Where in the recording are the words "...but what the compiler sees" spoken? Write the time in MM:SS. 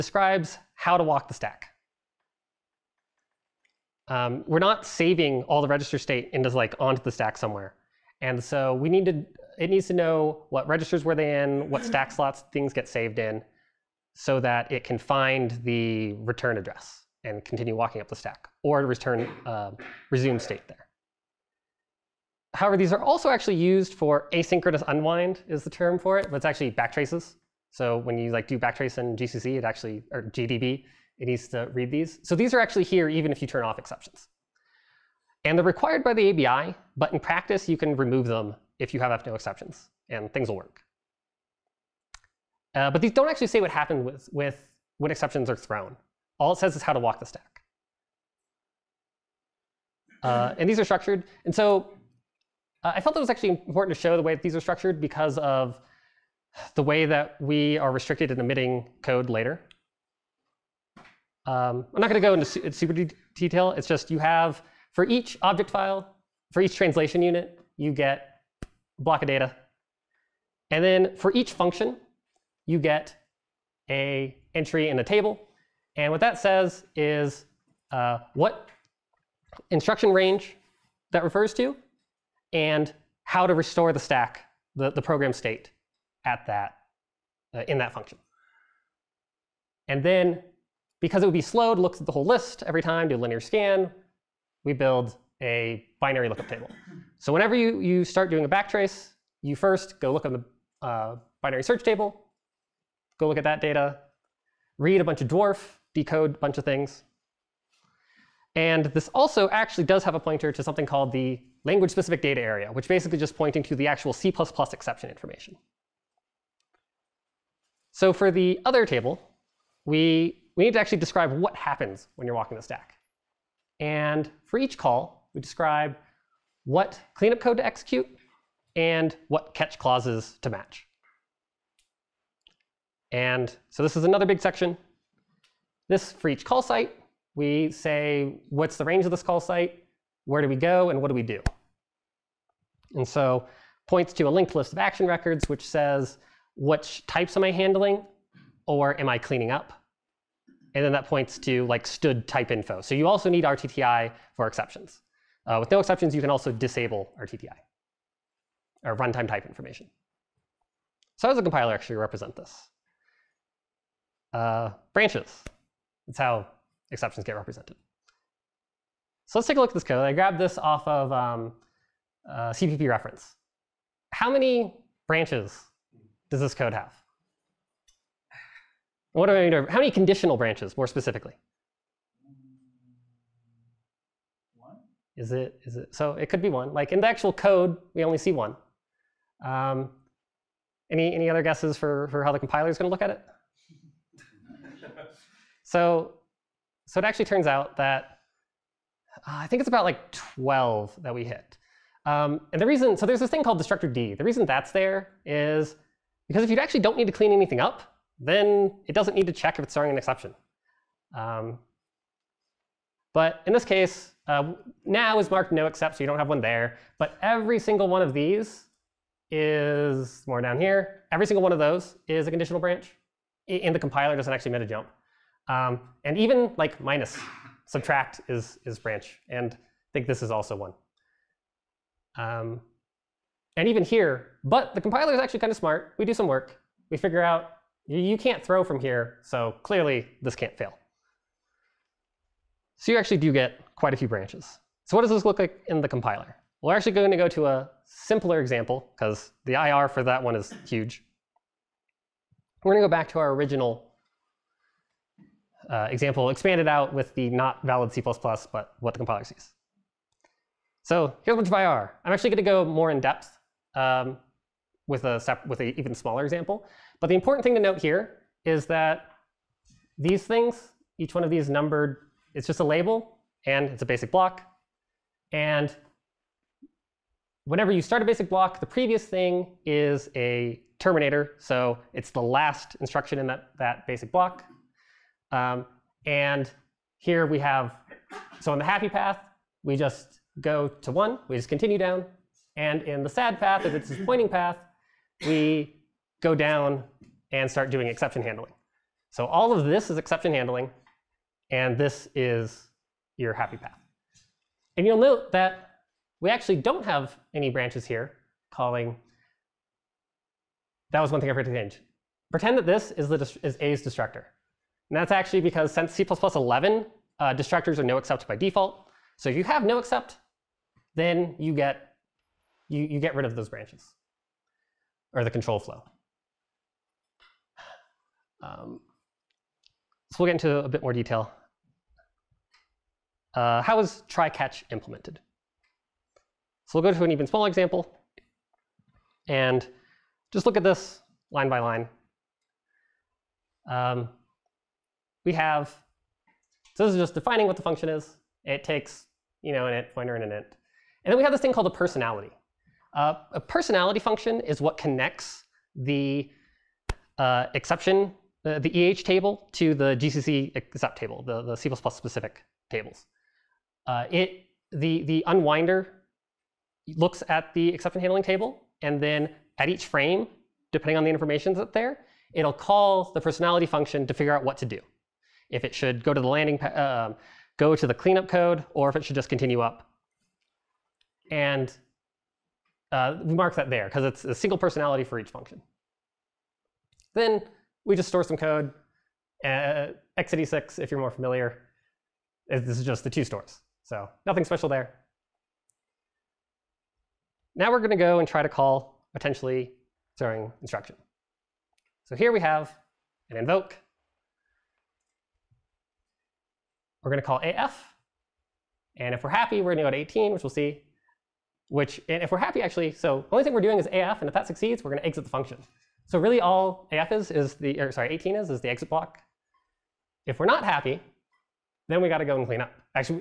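04:18.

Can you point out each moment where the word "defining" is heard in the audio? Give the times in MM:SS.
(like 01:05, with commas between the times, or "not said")
05:47.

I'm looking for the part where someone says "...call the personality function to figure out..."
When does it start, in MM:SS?
06:12.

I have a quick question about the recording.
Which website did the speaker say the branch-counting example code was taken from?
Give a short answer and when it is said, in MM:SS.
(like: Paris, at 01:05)
CPP reference, at 02:52.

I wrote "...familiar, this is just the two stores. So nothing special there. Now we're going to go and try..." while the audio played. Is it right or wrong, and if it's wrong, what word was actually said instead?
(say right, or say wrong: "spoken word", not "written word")
right.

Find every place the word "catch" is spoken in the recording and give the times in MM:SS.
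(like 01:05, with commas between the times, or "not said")
02:09, 05:34.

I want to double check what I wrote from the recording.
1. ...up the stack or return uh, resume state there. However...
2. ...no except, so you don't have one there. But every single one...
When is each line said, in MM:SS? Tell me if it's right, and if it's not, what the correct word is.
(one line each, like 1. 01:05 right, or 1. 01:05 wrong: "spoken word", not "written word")
1. 00:17 right
2. 03:35 right.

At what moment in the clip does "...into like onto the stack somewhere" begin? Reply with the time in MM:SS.
00:06.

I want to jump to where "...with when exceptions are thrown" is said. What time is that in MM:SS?
00:44.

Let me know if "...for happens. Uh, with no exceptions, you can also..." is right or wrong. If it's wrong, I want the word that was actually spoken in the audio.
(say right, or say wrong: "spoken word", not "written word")
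wrong: "exceptions", not "happens".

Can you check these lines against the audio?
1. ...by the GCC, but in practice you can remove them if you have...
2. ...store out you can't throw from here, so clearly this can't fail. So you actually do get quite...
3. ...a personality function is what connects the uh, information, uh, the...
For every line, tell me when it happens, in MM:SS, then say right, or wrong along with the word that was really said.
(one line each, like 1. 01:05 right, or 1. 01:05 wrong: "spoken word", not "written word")
1. 00:36 wrong: "ABI", not "GCC"
2. 03:56 wrong: "figure", not "store"
3. 05:53 wrong: "exception", not "information".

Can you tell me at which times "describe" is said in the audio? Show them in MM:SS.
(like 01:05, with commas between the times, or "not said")
02:00, 02:05.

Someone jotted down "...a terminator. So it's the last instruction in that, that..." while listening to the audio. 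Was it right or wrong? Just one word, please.
right.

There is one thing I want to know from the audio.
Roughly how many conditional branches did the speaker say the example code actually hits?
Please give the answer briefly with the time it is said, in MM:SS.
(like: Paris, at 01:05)
12, at 03:20.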